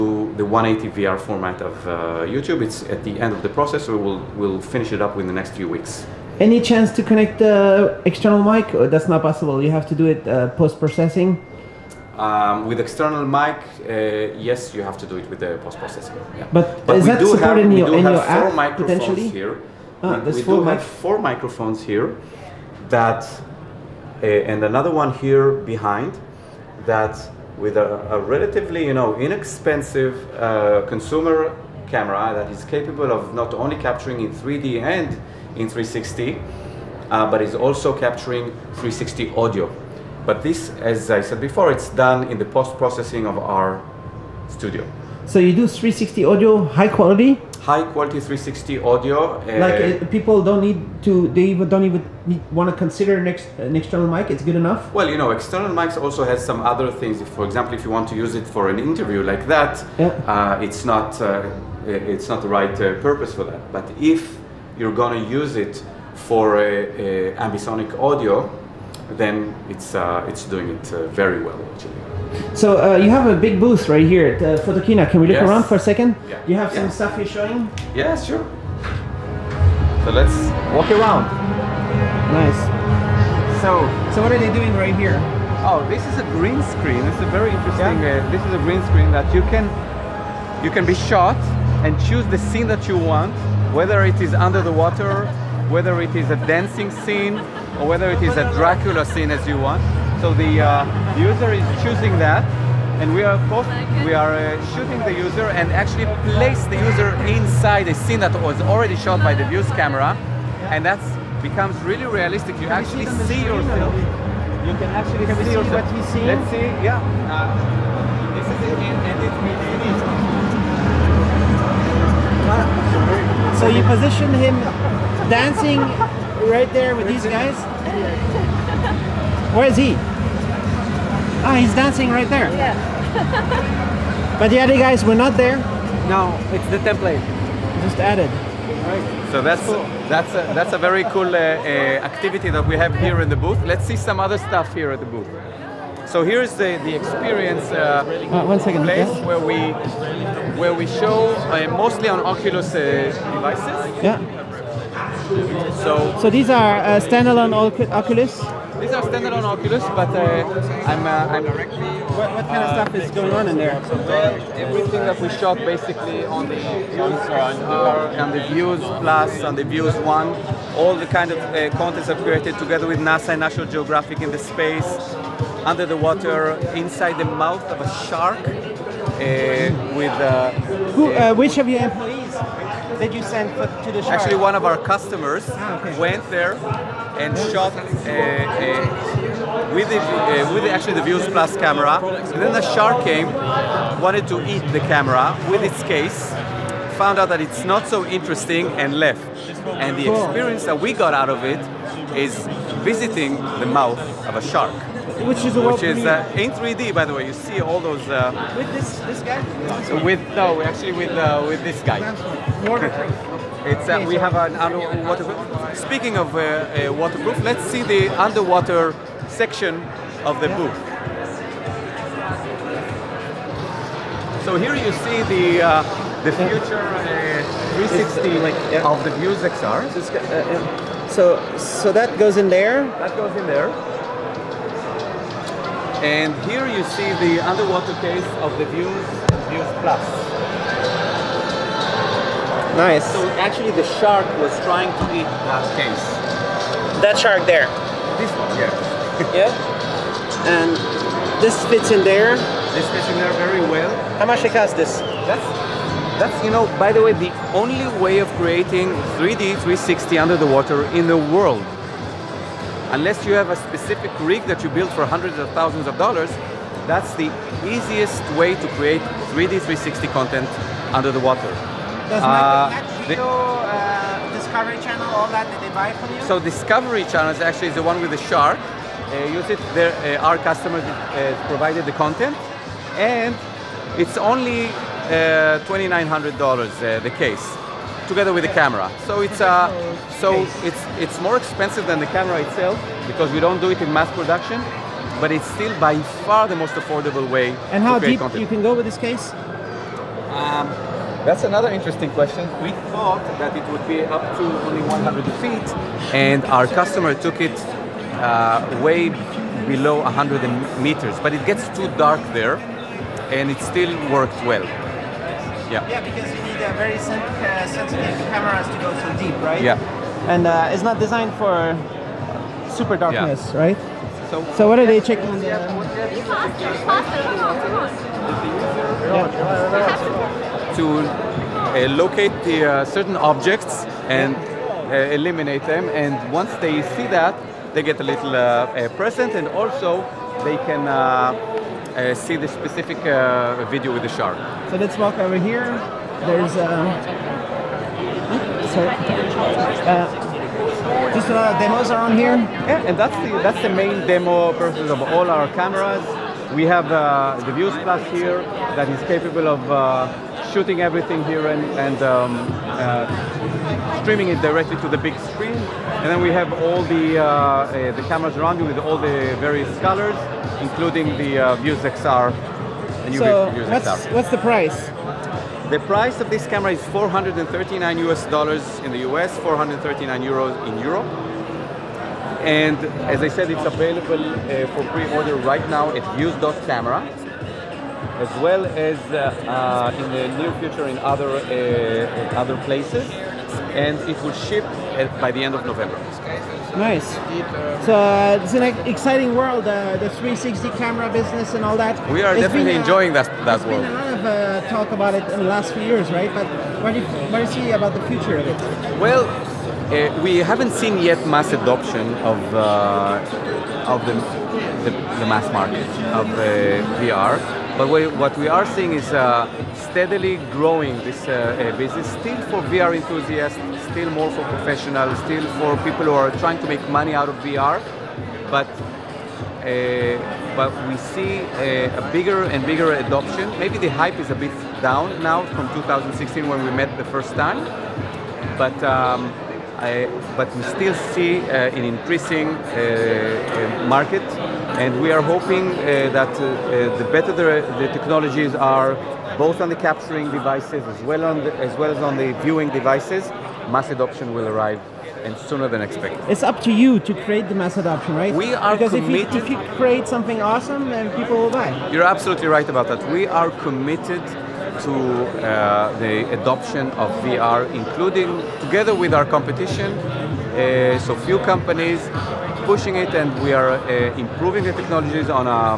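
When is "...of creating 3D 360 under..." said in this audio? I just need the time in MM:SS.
04:18.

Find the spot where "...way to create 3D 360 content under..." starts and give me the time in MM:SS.
04:28.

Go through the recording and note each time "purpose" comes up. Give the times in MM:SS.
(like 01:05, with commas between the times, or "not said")
01:02, 05:54.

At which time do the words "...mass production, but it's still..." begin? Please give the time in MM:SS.
04:53.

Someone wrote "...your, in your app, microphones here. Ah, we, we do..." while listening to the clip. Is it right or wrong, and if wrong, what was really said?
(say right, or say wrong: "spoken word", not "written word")
right.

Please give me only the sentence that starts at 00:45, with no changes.
So you do 360 audio, high quality, high quality 360 audio.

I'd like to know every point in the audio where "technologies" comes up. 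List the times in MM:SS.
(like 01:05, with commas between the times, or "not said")
07:27, 07:54.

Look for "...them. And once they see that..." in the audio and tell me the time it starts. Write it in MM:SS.
05:35.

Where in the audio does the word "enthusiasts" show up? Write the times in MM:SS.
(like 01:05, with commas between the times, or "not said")
07:02.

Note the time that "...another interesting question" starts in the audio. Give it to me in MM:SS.
05:01.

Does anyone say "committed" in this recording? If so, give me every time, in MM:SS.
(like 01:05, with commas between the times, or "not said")
07:38, 07:43.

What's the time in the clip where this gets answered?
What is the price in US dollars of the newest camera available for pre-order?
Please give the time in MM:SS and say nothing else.
06:16.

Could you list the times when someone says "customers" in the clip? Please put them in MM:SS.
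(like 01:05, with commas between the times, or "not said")
03:04, 04:40, 05:06.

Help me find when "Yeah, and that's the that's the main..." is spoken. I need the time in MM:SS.
05:52.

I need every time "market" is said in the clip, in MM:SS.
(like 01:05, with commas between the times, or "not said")
06:55, 07:23.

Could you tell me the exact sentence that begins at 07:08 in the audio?
But uh, but we see a, uh, a, bigger and bigger adoption.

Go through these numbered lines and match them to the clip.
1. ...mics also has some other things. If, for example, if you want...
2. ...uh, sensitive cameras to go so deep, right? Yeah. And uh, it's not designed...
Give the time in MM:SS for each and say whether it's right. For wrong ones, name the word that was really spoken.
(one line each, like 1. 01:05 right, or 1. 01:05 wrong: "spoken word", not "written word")
1. 00:55 right
2. 05:16 right.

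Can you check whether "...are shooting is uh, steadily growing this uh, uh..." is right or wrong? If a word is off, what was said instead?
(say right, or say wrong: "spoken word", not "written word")
wrong: "seeing", not "shooting".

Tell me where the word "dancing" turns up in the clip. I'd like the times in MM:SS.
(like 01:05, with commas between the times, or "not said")
01:36, 02:05, 02:11.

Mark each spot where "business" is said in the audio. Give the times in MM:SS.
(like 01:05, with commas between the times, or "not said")
06:41, 07:01.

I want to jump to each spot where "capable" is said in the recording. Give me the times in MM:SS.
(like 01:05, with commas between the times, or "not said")
00:32, 05:59.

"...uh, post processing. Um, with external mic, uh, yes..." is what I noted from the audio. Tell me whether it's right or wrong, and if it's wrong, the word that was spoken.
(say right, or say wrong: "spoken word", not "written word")
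right.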